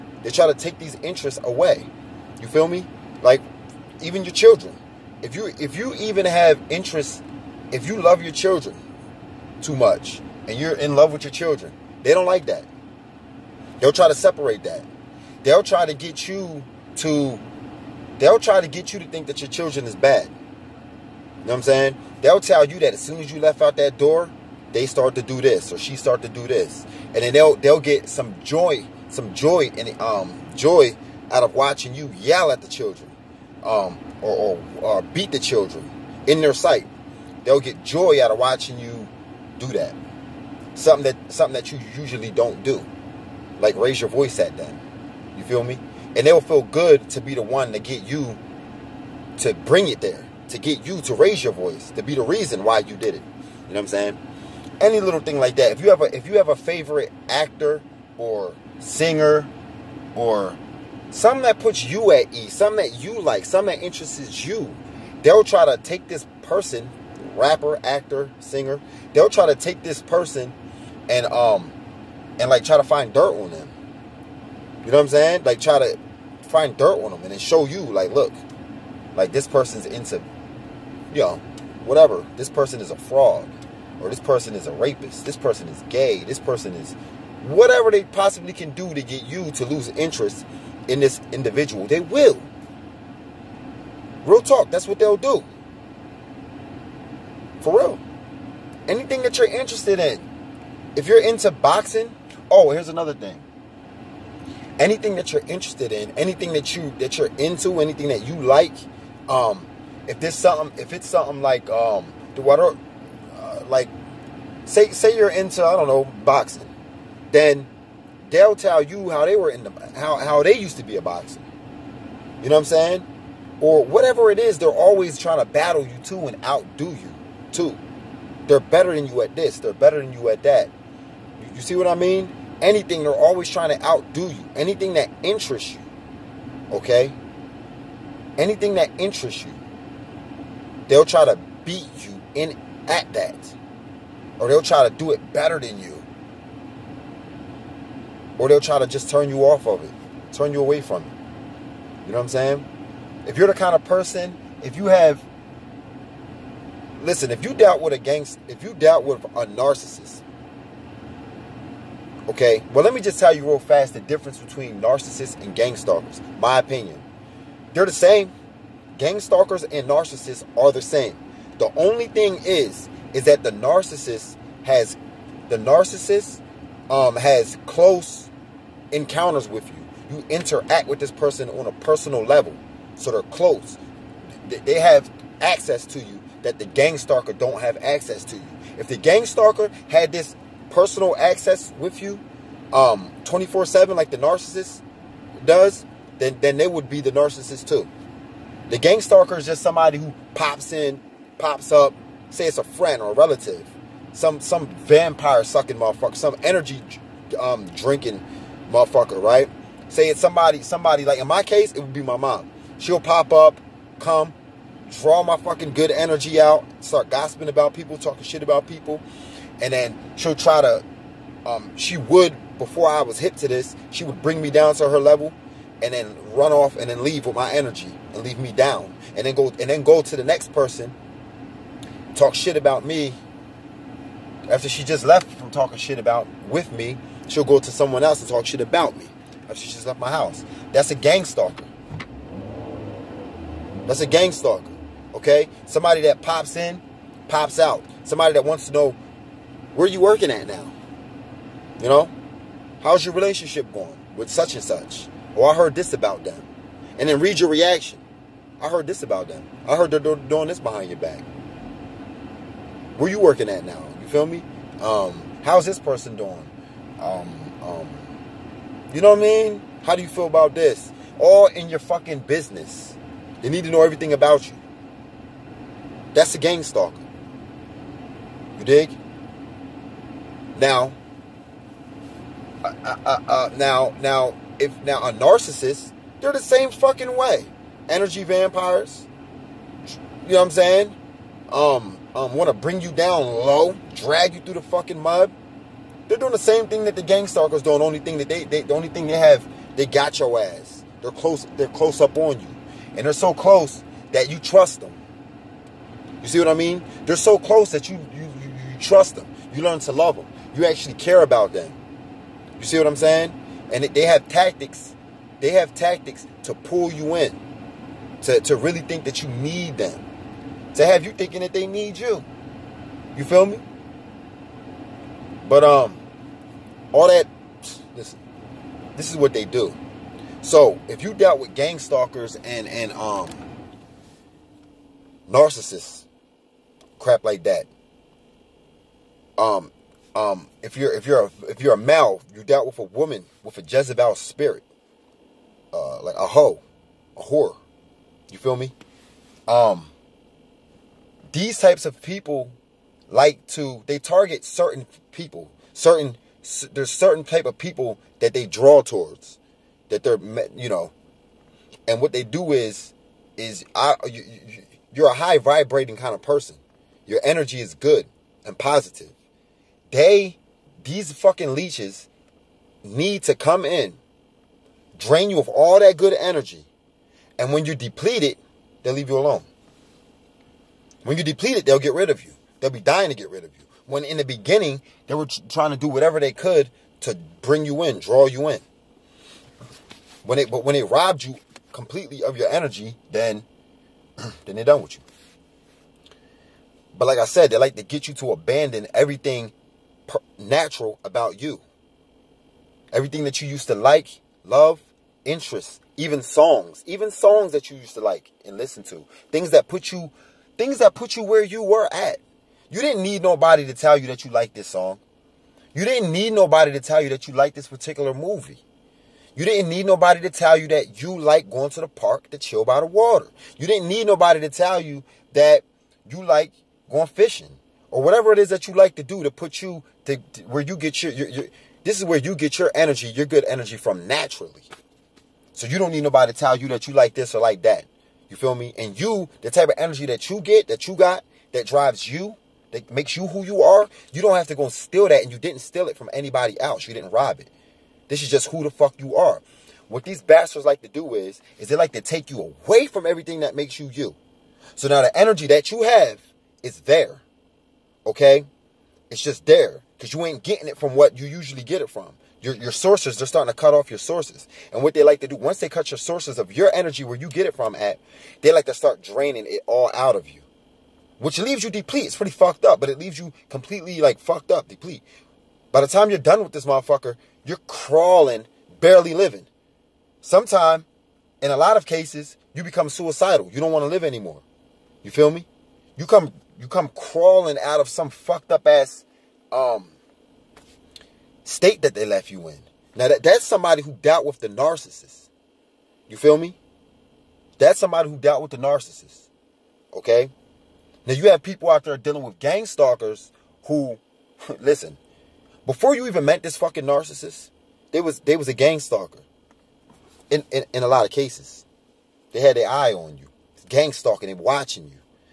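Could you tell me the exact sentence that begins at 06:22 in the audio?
They'll be dying to get rid of you.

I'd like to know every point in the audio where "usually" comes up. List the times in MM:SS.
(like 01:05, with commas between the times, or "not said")
00:41, 07:41.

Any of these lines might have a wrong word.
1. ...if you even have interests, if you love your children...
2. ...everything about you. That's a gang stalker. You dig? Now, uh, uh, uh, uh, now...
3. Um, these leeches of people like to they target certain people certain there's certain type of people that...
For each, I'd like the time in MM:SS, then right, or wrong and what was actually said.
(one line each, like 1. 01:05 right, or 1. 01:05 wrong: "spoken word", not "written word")
1. 00:05 right
2. 04:33 right
3. 05:49 wrong: "types", not "leeches".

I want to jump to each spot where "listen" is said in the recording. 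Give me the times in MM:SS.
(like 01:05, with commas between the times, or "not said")
02:37, 05:27, 06:48, 08:24.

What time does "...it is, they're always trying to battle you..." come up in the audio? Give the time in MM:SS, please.
02:04.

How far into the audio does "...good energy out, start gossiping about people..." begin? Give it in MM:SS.
03:35.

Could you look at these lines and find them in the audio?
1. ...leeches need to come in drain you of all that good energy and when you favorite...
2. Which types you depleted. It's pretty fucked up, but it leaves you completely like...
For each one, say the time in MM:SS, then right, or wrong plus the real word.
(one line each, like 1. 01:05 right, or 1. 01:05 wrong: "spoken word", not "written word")
1. 06:11 wrong: "deplete", not "favorite"
2. 07:51 wrong: "leaves", not "types".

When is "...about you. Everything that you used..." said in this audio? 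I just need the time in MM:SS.
06:41.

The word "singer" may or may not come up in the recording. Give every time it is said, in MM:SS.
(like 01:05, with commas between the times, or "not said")
00:58, 01:08.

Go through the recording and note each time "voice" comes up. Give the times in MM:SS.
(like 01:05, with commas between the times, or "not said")
00:44, 00:51.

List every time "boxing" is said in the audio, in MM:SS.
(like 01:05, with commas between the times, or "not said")
01:41, 01:56.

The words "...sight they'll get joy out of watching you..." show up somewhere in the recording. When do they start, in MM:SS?
00:36.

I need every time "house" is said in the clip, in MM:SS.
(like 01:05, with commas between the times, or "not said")
04:00.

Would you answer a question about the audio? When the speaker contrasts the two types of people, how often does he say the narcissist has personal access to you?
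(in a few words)
24/7.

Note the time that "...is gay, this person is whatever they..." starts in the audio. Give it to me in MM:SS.
01:25.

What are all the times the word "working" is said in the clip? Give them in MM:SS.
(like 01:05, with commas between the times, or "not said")
04:10, 04:23.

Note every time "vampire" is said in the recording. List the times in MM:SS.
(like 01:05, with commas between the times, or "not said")
03:24, 04:48.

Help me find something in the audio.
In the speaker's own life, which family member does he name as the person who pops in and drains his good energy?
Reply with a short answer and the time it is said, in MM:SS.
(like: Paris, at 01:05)
My mom, at 03:32.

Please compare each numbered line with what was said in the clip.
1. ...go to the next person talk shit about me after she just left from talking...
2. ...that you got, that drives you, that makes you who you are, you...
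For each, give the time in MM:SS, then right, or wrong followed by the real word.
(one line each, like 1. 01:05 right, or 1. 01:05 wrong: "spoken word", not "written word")
1. 03:49 right
2. 07:20 right.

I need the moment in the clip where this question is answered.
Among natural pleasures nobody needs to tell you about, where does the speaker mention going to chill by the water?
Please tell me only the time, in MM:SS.
07:01.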